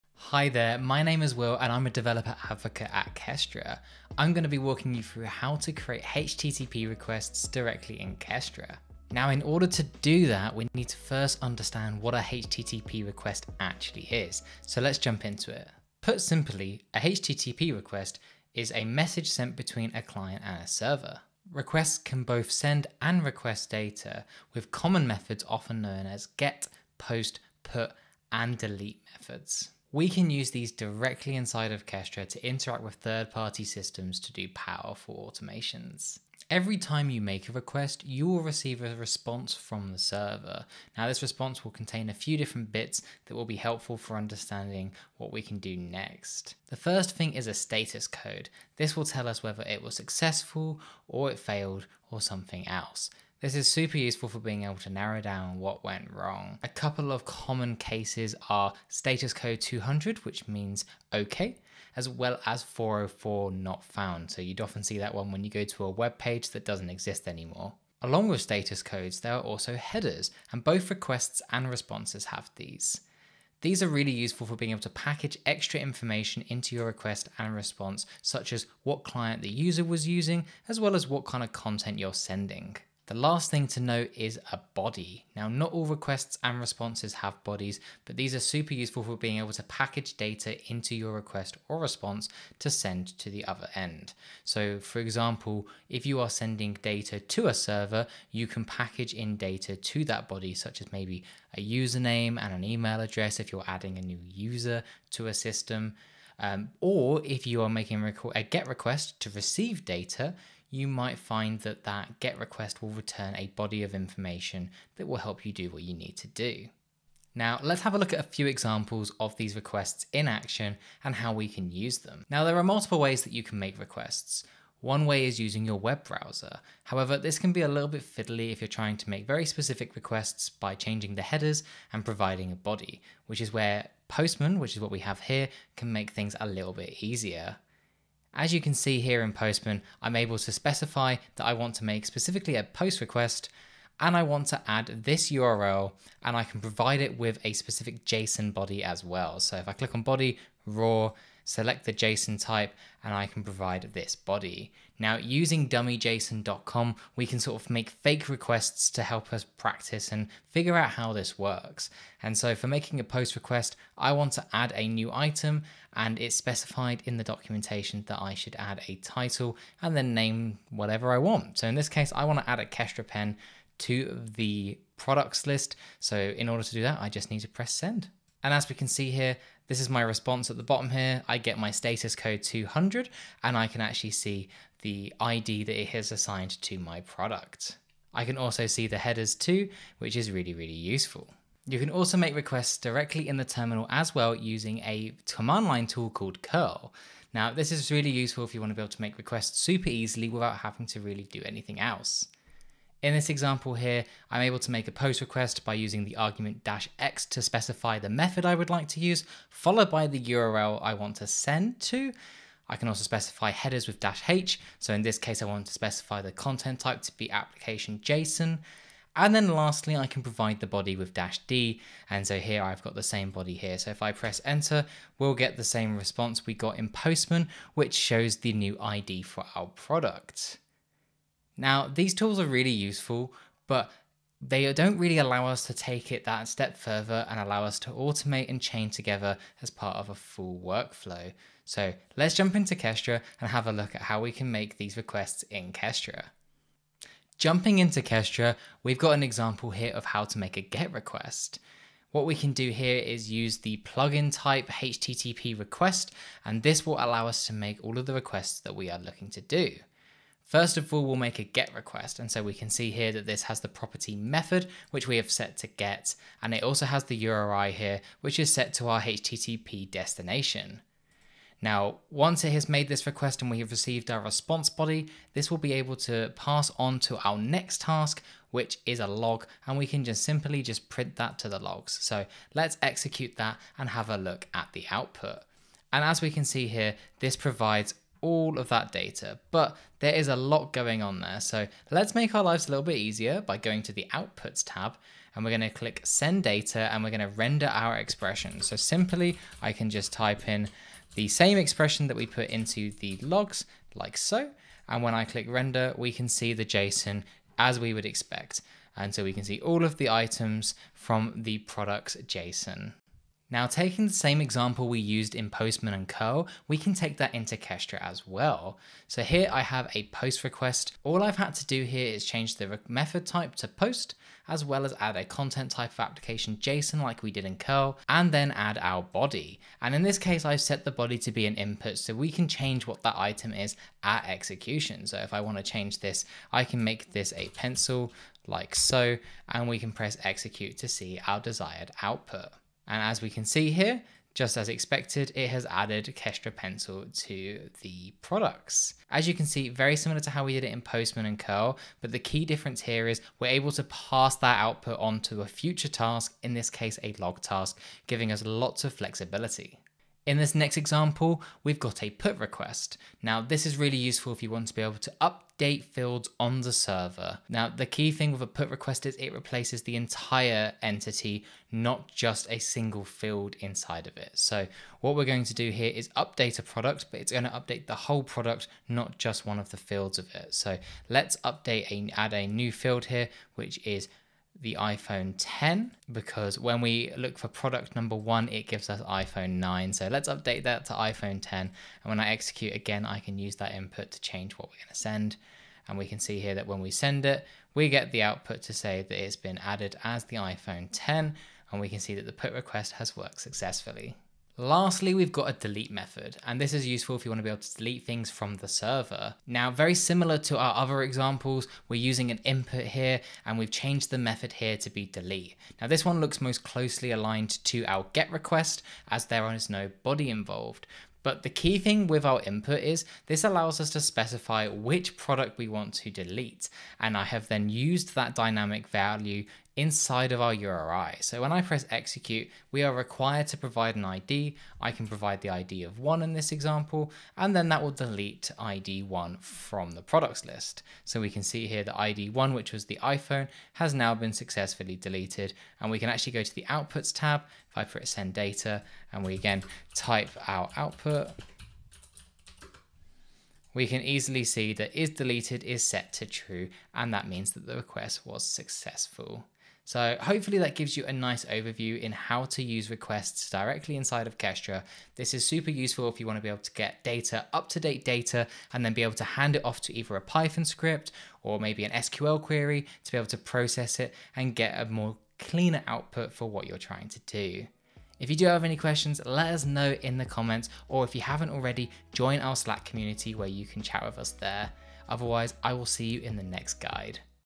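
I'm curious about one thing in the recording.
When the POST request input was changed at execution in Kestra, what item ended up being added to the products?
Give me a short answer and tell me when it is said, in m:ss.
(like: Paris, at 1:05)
Kestra Pencil, at 5:46.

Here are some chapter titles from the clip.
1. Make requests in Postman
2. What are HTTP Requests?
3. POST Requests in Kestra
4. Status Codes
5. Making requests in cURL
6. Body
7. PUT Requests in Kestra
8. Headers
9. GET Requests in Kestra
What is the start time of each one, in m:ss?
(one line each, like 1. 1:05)
1. 2:02
2. 0:15
3. 5:13
4. 0:46
5. 3:11
6. 1:23
7. 6:00
8. 1:08
9. 4:06.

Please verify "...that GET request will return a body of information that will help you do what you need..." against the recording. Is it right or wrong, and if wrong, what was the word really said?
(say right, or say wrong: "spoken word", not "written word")
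right.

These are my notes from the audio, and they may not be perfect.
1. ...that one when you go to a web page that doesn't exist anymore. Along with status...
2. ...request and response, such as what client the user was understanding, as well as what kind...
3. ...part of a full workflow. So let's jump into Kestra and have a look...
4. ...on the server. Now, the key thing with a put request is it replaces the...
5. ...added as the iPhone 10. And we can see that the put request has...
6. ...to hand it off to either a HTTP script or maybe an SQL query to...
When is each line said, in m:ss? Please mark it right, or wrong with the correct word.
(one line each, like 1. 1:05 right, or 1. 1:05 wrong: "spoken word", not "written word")
1. 1:04 right
2. 1:16 wrong: "using", not "understanding"
3. 3:59 right
4. 6:06 right
5. 6:39 right
6. 7:49 wrong: "Python", not "HTTP".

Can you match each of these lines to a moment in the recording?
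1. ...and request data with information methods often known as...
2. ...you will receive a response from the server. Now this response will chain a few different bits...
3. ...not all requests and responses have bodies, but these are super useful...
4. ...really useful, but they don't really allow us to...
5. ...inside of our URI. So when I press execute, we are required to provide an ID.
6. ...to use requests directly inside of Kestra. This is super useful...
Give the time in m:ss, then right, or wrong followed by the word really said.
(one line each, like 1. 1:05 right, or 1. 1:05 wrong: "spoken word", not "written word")
1. 0:23 wrong: "common", not "information"
2. 0:38 wrong: "contain", not "chain"
3. 1:25 right
4. 3:52 right
5. 7:09 right
6. 7:42 right.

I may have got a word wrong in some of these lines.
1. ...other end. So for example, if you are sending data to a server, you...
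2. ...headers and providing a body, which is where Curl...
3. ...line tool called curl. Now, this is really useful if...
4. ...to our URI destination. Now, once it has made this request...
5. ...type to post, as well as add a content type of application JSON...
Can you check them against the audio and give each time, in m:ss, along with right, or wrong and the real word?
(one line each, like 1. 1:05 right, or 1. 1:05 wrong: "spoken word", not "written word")
1. 1:33 right
2. 2:11 wrong: "Postman", not "Curl"
3. 3:15 right
4. 4:28 wrong: "HTTP", not "URI"
5. 5:23 right.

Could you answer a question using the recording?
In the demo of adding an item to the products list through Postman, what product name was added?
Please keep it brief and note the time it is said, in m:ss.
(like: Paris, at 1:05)
Kestra pen, at 2:52.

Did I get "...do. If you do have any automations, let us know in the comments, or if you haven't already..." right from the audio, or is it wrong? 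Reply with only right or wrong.
wrong.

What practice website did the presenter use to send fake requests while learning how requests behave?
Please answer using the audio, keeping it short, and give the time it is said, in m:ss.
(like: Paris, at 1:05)
dummyjson.com, at 2:35.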